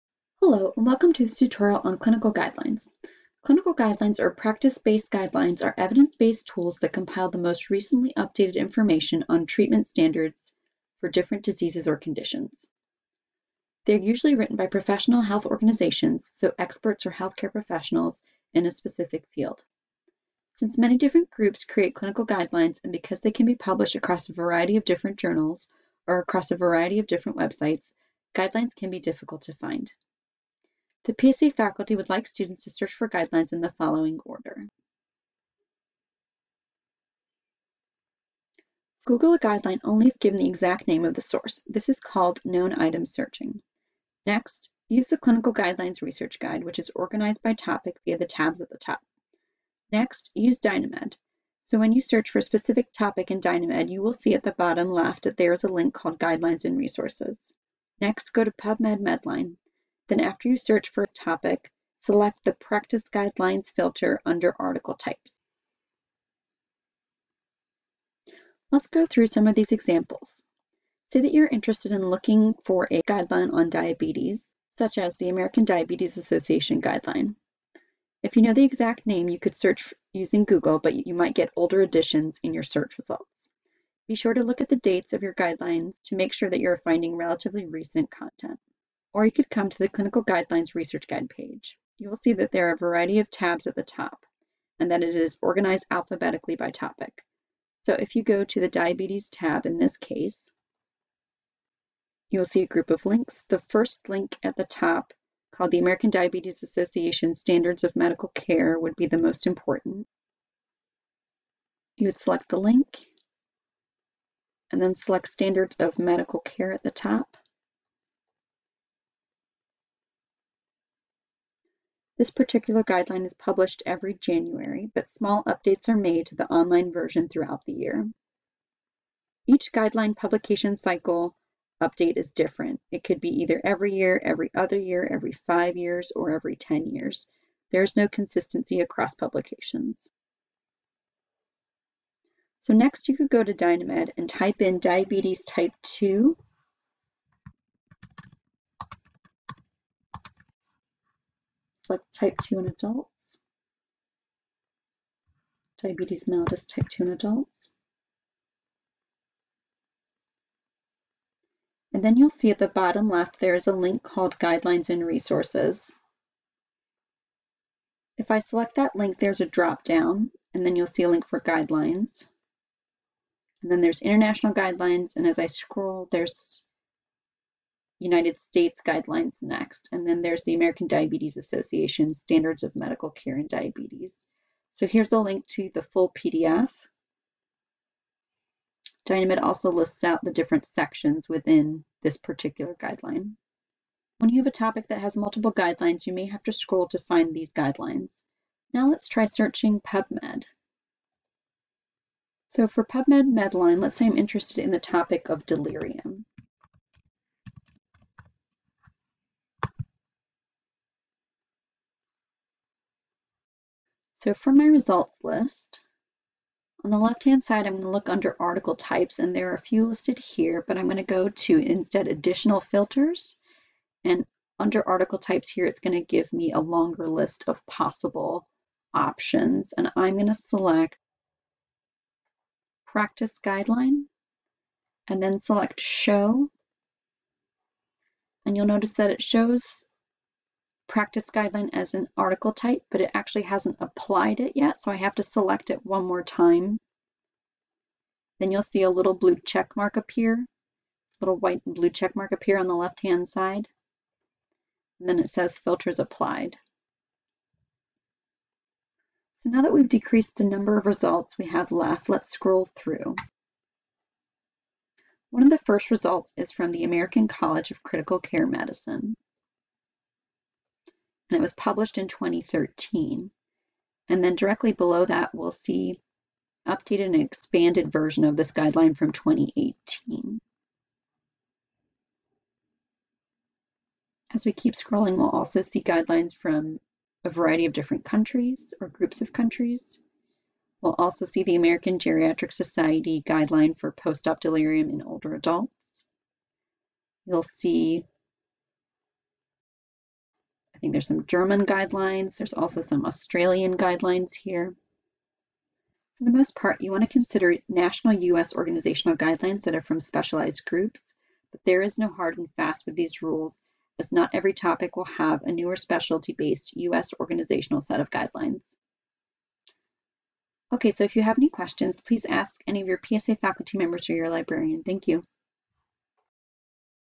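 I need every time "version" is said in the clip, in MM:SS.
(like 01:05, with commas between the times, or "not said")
02:06, 04:37.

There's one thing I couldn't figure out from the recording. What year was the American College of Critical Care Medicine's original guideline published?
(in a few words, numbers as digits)
2013.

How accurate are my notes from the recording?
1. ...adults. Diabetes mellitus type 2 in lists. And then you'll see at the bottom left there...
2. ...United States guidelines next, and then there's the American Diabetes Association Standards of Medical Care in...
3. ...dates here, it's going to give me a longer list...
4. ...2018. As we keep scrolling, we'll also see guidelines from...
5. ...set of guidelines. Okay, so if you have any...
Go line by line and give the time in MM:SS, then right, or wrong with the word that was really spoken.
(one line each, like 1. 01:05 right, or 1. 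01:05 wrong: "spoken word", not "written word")
1. 02:32 wrong: "adults", not "lists"
2. 02:58 right
3. 03:45 wrong: "types", not "dates"
4. 04:39 right
5. 05:17 right.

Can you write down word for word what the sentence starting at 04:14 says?
And then it says filters applied.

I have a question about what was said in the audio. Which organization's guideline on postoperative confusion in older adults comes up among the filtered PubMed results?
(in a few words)
American Geriatric Society.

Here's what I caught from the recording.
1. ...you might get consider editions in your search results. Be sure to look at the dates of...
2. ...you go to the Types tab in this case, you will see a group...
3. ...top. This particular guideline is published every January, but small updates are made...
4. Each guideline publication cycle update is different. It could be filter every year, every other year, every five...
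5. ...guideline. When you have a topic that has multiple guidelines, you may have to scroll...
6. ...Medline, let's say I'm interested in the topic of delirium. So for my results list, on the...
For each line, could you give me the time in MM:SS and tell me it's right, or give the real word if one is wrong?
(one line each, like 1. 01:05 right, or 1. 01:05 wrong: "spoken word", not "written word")
1. 01:21 wrong: "older", not "consider"
2. 01:38 wrong: "Diabetes", not "Types"
3. 01:56 right
4. 02:09 wrong: "either", not "filter"
5. 03:12 right
6. 03:23 right.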